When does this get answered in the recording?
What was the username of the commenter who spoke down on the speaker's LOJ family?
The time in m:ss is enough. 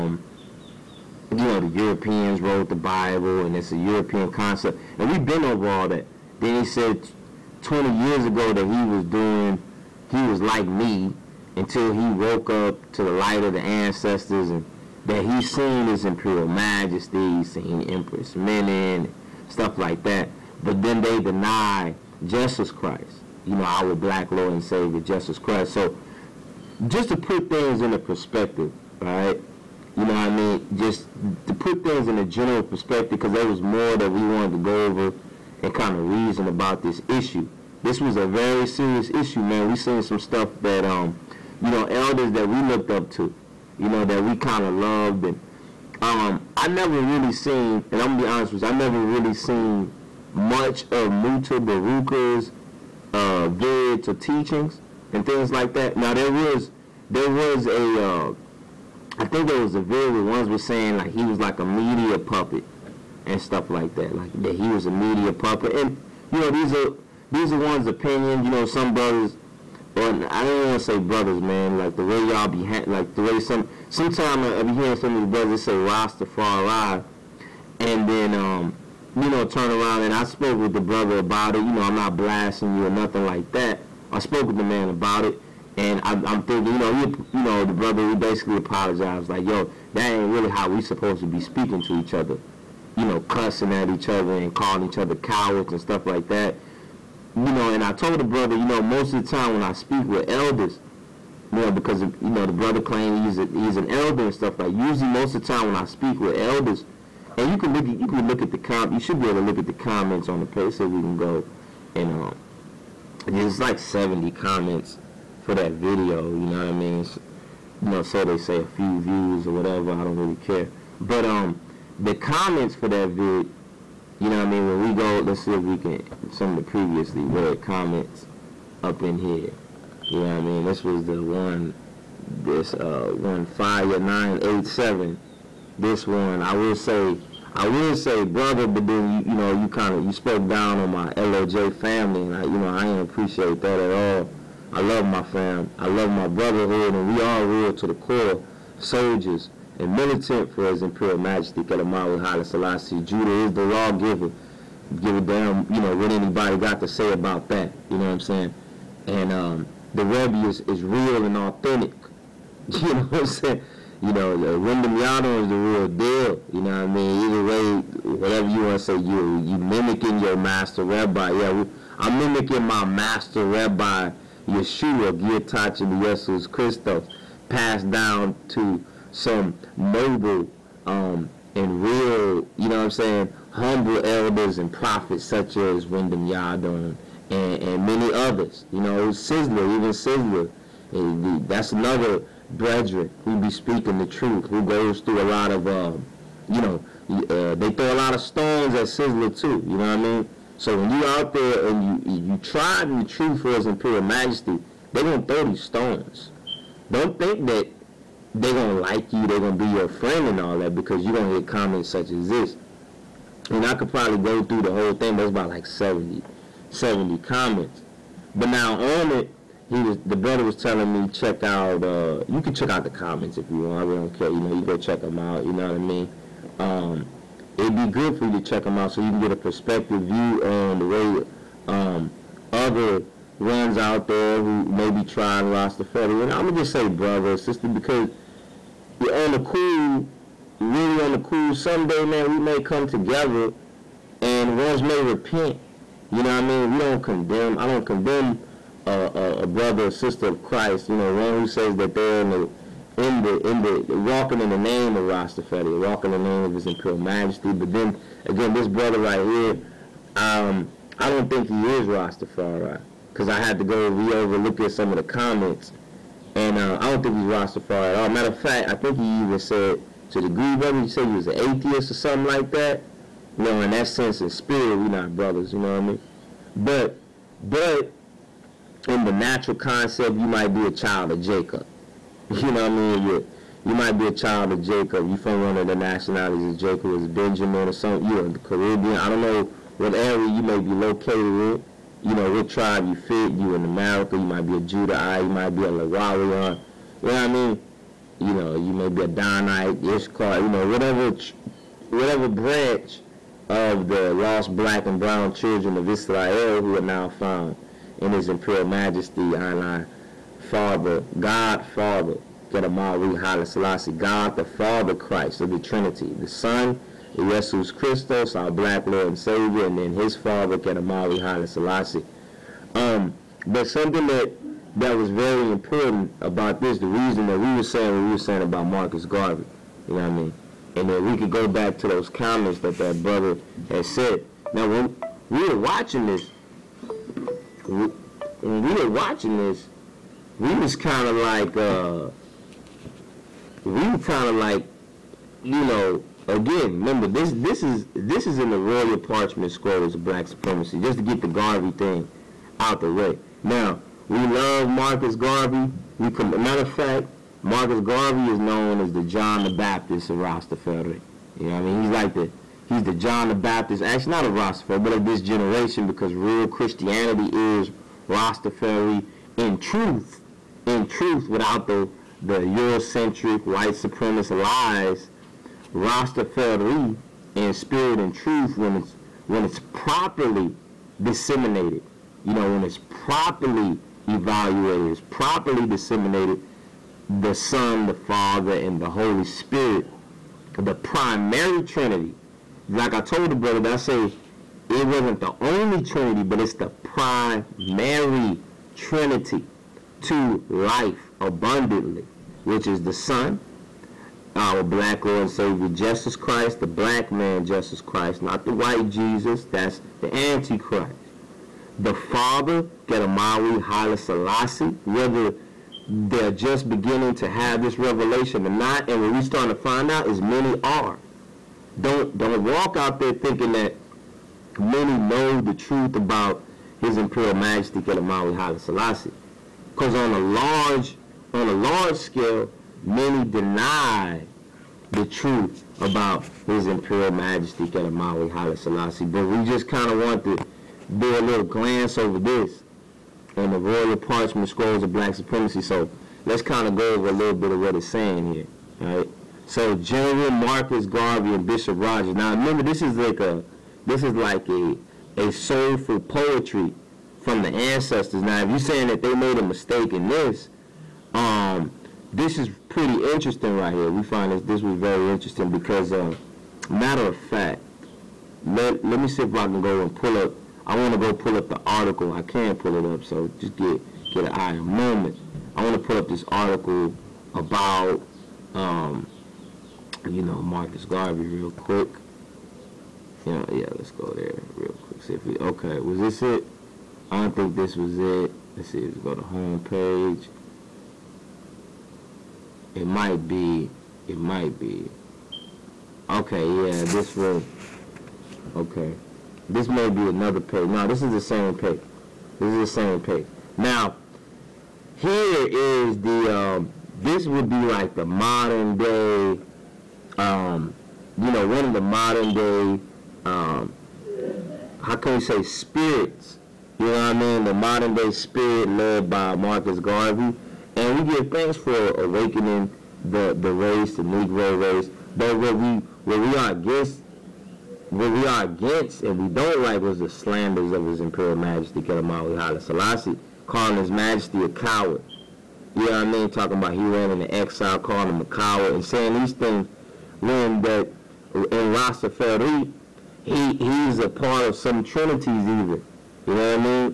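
2:13.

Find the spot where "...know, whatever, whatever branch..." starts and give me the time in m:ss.
5:00.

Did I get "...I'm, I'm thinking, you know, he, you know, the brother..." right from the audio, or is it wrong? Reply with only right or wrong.
right.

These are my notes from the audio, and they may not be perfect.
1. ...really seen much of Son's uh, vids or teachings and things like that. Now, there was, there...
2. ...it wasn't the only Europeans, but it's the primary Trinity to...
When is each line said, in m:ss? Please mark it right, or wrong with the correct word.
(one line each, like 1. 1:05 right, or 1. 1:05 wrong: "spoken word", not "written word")
1. 0:48 wrong: "Mutabaruka", not "Son"
2. 6:34 wrong: "Trinity", not "Europeans".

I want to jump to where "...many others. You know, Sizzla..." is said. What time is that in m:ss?
3:07.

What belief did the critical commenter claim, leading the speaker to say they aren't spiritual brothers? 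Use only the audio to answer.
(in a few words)
atheist.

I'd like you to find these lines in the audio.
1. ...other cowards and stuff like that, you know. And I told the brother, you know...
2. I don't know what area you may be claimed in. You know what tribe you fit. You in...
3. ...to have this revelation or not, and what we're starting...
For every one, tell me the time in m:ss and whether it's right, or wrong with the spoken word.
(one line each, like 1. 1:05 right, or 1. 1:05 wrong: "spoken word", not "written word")
1. 1:34 right
2. 4:48 wrong: "located", not "claimed"
3. 6:57 right.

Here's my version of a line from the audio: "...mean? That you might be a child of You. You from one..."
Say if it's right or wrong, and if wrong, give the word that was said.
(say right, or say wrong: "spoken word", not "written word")
wrong: "Jacob", not "You".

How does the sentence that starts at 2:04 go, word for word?
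When we go, let's see if we can some of the previously read comments up in here.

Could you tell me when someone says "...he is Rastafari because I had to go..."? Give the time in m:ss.
4:21.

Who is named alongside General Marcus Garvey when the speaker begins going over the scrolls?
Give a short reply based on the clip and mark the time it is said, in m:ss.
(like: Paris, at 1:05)
Bishop Rogers, at 7:31.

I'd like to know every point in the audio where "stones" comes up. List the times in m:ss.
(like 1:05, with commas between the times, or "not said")
3:18, 3:25.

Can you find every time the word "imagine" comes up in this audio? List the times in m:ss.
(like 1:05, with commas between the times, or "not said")
not said.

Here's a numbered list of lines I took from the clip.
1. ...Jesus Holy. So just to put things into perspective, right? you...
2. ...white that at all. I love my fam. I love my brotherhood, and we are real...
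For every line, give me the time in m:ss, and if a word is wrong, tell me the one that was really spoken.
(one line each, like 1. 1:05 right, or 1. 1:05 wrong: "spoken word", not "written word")
1. 0:24 wrong: "Christ", not "Holy"
2. 2:23 wrong: "appreciate", not "white".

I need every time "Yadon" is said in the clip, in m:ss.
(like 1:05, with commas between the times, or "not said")
2:44, 3:06.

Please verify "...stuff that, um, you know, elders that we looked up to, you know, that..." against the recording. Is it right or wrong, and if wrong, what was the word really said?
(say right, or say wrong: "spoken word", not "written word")
right.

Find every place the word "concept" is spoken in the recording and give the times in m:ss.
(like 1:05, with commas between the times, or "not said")
0:04, 4:39.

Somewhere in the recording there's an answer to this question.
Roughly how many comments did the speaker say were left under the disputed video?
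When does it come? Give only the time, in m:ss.
1:53.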